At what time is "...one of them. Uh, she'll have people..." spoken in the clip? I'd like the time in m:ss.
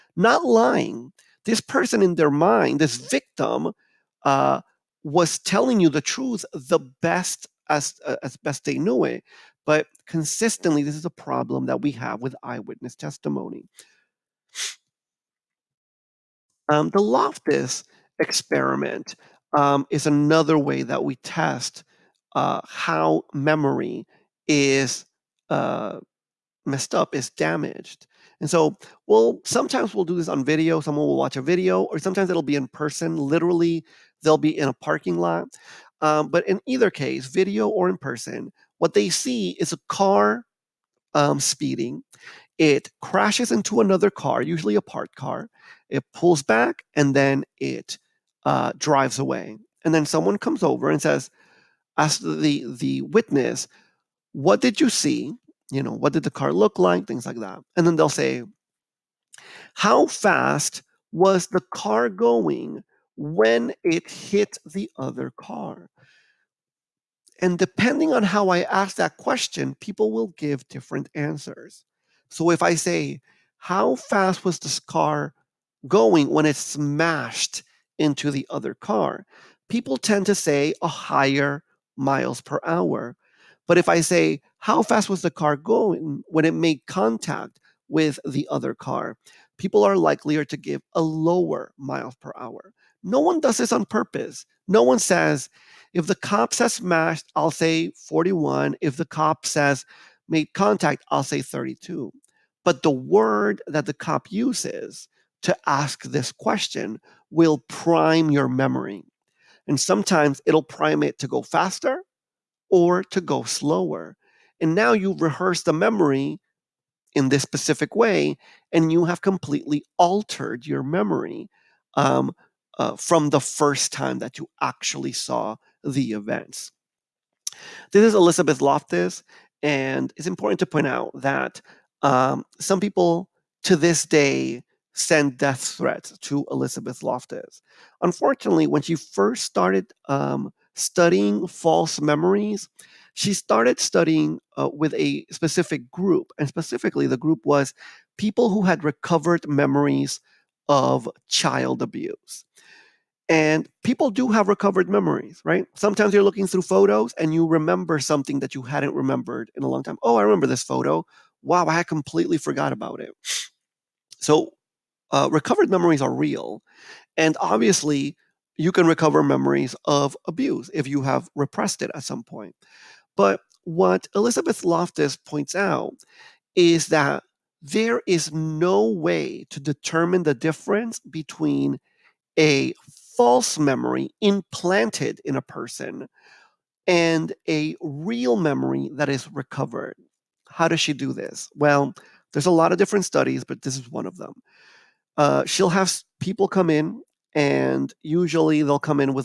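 3:13.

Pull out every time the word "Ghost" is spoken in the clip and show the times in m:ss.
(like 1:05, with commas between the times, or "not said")
not said.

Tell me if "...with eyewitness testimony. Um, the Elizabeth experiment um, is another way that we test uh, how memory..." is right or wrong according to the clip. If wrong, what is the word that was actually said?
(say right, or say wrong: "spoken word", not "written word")
wrong: "Loftus", not "Elizabeth".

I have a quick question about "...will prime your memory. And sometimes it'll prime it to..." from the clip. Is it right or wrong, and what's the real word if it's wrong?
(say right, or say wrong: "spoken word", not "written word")
right.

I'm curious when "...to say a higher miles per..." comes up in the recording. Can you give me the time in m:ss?
1:20.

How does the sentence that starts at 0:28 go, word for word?
And so, well, sometimes we'll do this on video.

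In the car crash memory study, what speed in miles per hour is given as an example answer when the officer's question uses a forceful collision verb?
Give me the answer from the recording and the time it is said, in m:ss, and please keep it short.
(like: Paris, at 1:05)
41, at 1:38.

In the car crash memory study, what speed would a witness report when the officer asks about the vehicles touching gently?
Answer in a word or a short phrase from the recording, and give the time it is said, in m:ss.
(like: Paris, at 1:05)
32, at 1:41.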